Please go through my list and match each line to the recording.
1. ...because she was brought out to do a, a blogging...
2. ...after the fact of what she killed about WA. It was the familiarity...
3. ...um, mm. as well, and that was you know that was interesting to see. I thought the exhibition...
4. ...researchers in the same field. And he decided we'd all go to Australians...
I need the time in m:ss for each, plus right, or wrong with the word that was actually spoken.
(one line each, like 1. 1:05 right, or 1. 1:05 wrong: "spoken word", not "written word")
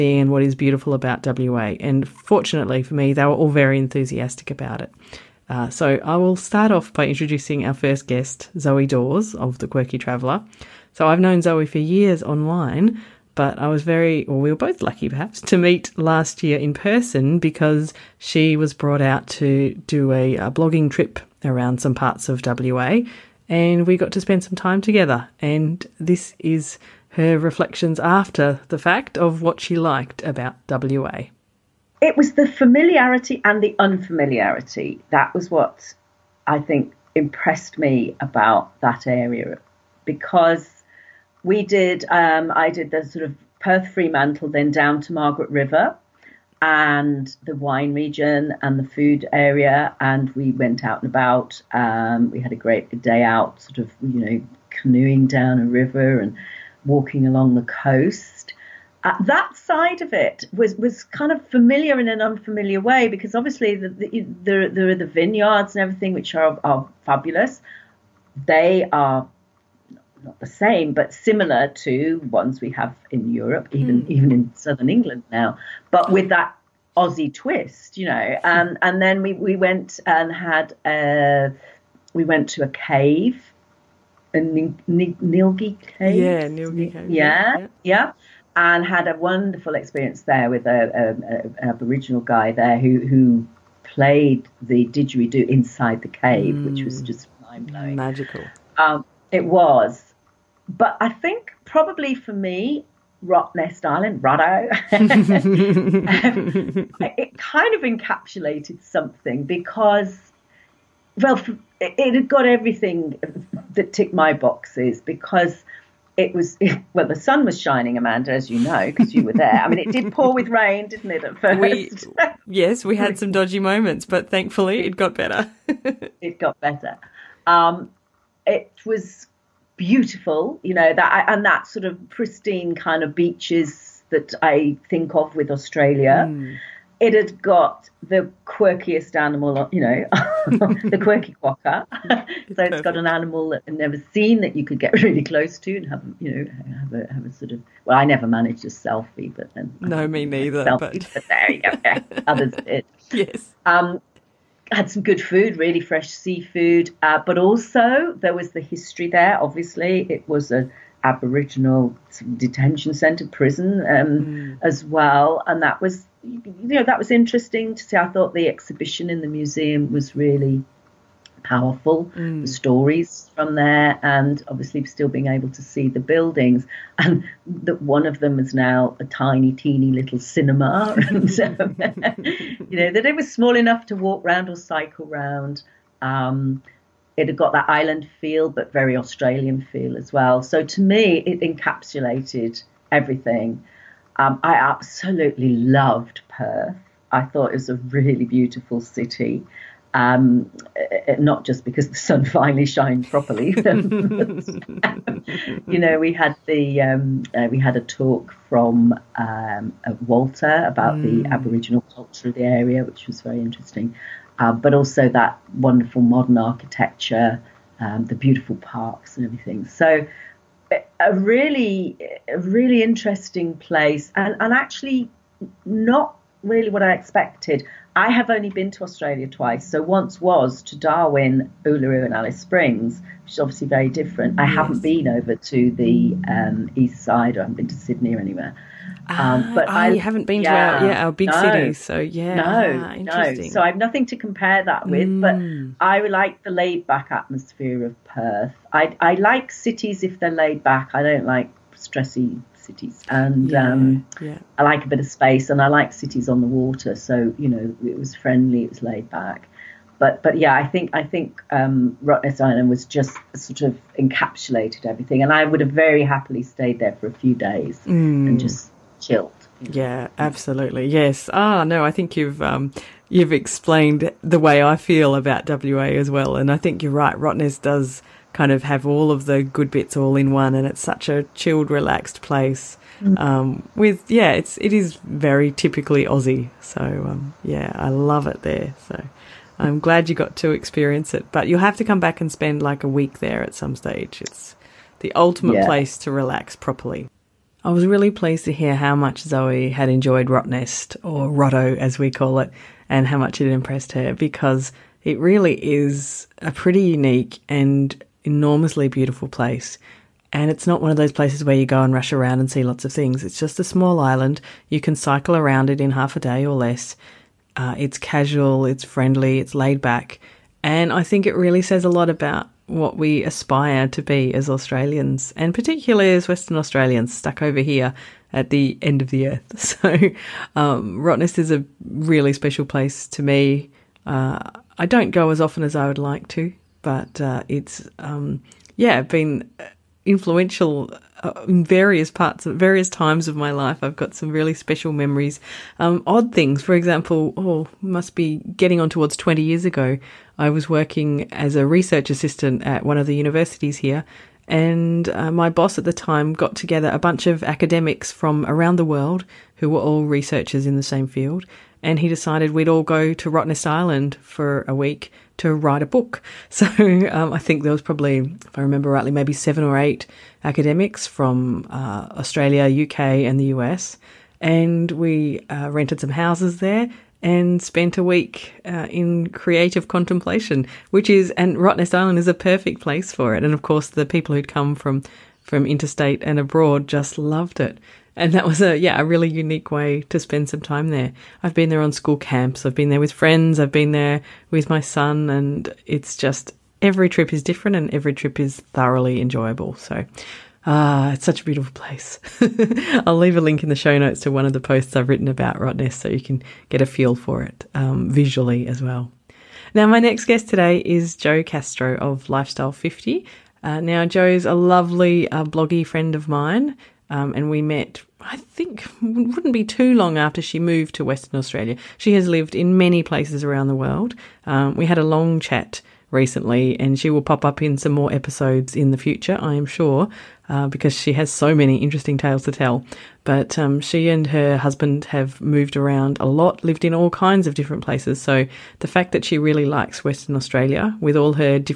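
1. 0:17 right
2. 0:27 wrong: "liked", not "killed"
3. 2:43 right
4. 6:00 wrong: "Rottnest", not "Australians".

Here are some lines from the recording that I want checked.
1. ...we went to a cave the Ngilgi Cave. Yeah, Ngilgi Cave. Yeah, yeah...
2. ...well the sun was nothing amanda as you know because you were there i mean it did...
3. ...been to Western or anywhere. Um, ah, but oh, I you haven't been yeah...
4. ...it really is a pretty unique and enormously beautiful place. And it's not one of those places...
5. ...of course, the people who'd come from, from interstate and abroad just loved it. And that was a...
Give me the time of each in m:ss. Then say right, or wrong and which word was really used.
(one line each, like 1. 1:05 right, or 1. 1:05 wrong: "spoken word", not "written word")
1. 1:22 right
2. 1:56 wrong: "shining", not "nothing"
3. 3:57 wrong: "Sydney", not "Western"
4. 5:05 right
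5. 6:23 right.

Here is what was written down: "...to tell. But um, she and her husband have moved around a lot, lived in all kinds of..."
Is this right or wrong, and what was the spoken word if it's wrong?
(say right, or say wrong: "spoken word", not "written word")
right.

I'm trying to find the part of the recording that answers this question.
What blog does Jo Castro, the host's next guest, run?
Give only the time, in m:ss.
6:52.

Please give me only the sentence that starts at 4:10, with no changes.
I don't like stressy cities, and yeah, um, yeah.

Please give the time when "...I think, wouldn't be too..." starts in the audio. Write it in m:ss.
6:58.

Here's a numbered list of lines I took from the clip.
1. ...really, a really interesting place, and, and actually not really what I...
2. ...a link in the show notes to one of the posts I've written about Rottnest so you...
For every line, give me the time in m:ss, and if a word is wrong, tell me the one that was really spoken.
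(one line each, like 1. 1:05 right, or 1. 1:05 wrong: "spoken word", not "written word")
1. 3:41 right
2. 6:43 right.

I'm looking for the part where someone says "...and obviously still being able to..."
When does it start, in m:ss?
2:54.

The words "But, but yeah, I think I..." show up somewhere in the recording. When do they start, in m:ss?
4:19.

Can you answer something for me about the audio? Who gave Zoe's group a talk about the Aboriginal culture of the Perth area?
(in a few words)
Walter.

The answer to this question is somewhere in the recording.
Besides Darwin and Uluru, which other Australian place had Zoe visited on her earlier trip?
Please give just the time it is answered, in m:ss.
3:52.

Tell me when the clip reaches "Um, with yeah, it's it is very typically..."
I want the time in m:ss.
4:43.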